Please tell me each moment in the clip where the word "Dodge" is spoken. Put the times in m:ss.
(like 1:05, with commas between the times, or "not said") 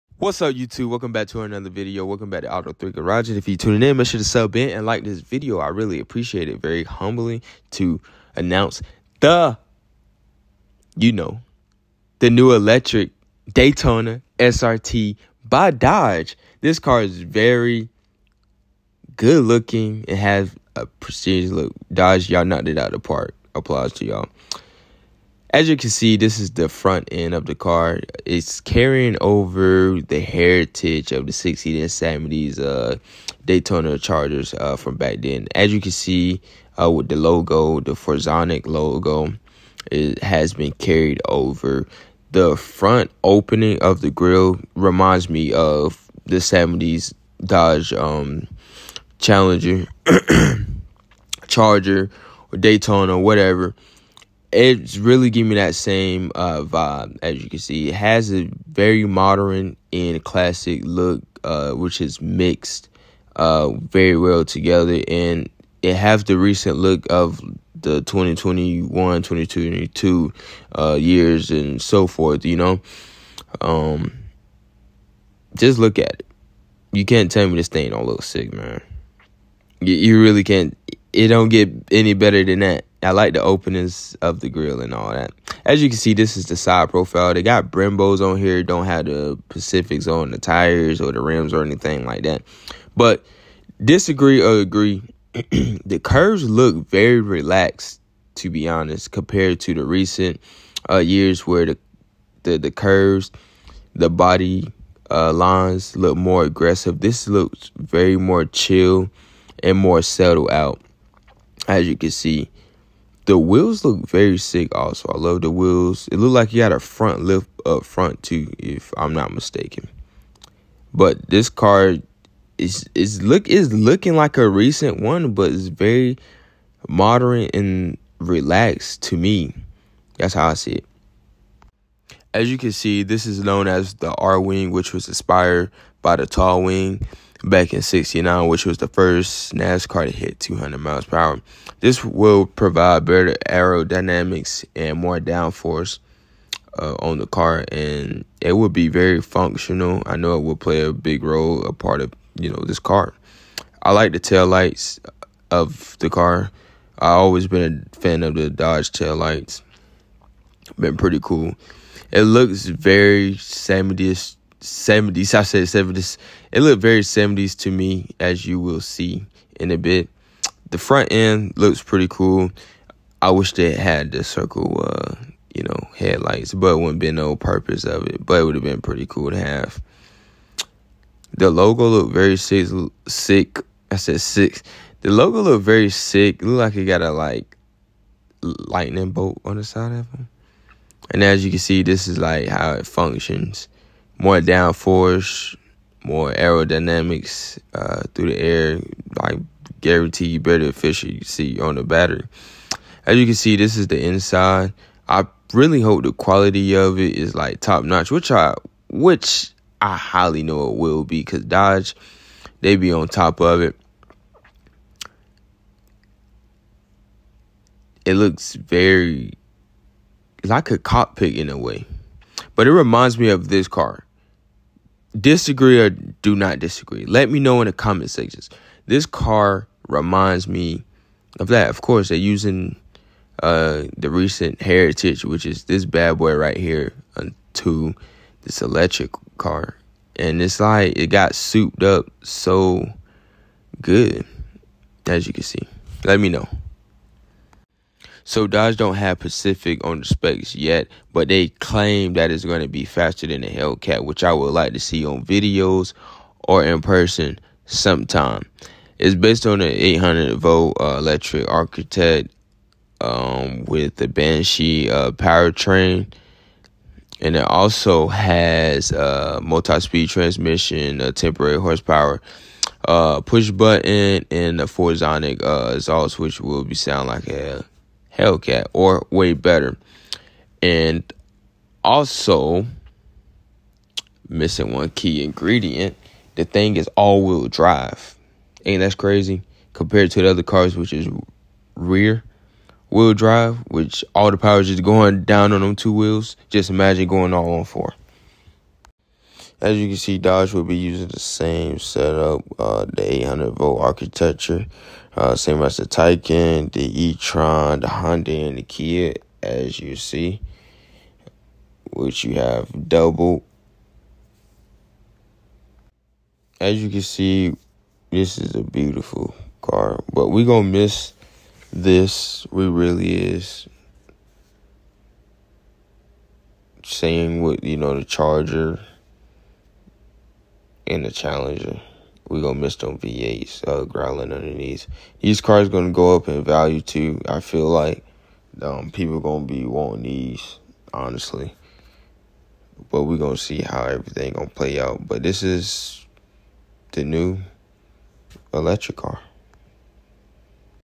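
0:15, 0:21, 0:47, 2:38, 3:31, 4:08, 5:00.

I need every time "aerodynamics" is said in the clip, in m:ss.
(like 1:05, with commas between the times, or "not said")
2:23, 3:16.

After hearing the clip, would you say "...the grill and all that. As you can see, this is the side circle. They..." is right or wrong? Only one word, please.
wrong.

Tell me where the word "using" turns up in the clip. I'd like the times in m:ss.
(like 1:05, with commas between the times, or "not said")
3:52, 5:00.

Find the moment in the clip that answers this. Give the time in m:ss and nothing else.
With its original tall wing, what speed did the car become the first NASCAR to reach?
2:20.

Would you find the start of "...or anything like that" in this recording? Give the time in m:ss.
1:31.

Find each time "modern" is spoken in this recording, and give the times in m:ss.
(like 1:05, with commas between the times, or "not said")
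0:59, 2:06.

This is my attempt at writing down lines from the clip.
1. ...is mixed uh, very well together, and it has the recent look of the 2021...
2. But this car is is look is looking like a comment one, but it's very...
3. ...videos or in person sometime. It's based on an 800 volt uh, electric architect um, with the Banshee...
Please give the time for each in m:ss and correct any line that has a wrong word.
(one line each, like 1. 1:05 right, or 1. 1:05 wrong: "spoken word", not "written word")
1. 1:02 right
2. 2:00 wrong: "recent", not "comment"
3. 4:15 right.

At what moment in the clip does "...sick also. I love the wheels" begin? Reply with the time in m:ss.
1:54.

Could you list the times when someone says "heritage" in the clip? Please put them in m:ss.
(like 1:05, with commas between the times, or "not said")
0:30, 3:54.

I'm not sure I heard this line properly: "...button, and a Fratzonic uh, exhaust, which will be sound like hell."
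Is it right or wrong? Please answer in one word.
right.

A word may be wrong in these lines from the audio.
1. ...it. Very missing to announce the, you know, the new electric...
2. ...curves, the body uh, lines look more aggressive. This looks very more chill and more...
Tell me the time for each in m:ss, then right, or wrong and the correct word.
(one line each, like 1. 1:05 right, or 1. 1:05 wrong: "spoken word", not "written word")
1. 0:06 wrong: "humbling", not "missing"
2. 1:42 right.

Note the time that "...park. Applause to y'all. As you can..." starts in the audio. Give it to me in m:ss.
0:23.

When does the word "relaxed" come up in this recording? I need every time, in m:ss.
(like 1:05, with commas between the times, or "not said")
1:37, 2:08.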